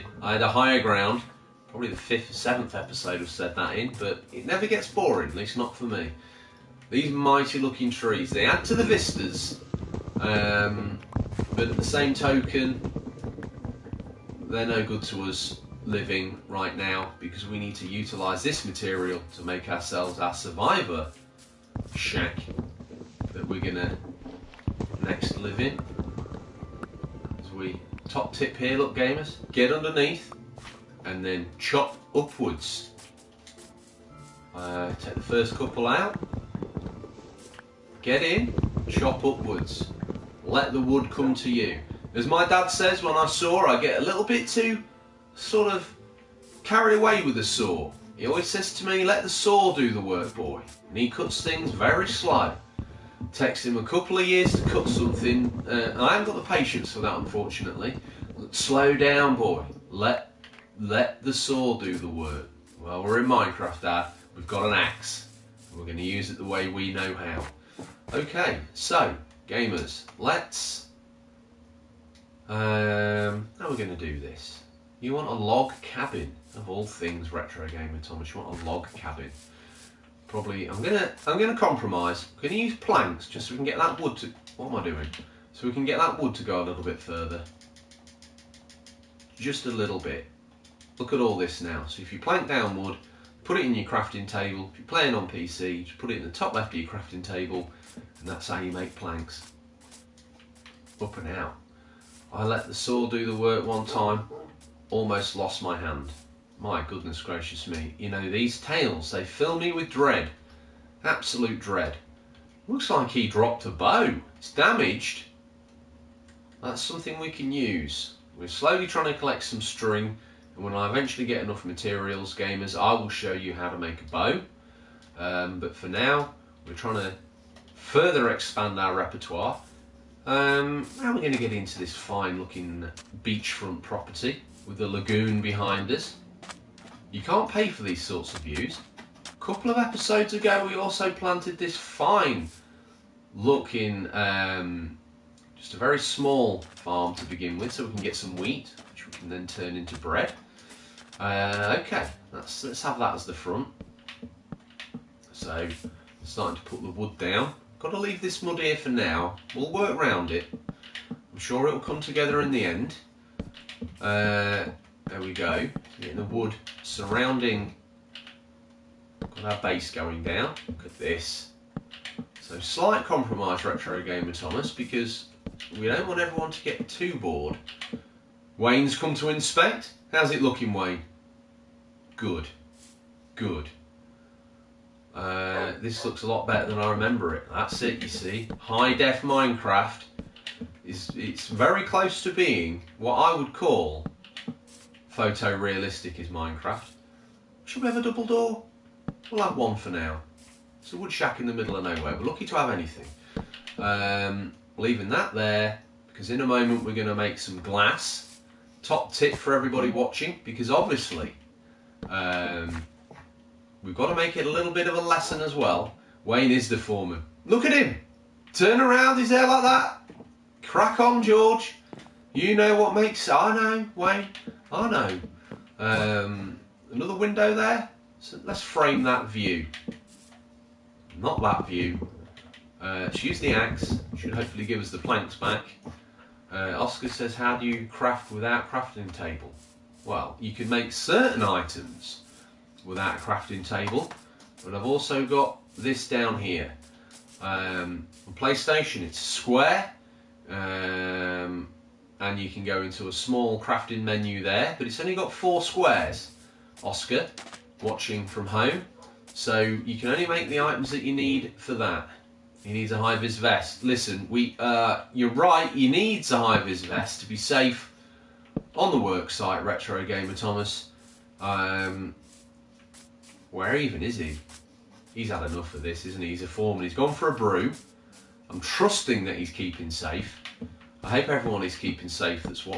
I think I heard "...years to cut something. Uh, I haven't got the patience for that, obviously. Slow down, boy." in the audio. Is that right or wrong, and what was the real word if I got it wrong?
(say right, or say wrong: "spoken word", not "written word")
wrong: "unfortunately", not "obviously".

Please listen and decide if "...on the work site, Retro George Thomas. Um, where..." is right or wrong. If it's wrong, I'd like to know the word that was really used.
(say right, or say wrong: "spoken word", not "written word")
wrong: "Gamer", not "George".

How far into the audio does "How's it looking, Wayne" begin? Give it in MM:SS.
03:00.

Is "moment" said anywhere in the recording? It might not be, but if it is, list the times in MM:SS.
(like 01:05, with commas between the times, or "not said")
03:26.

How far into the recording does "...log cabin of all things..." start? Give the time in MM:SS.
01:15.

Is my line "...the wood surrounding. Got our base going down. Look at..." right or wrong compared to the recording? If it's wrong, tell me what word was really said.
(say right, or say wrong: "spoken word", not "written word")
right.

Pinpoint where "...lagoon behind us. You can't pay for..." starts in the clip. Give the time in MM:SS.
02:14.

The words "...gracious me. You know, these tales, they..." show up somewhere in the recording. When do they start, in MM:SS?
01:47.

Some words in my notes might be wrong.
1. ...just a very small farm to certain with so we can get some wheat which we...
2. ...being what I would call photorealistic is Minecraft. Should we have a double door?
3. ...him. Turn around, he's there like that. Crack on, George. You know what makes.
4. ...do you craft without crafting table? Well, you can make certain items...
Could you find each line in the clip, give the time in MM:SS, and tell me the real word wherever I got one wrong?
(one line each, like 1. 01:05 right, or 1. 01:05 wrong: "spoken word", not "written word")
1. 02:25 wrong: "begin", not "certain"
2. 03:12 right
3. 03:37 right
4. 03:57 right.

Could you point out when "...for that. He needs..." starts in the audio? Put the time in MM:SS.
04:21.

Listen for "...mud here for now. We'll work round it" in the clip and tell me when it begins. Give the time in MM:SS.
02:38.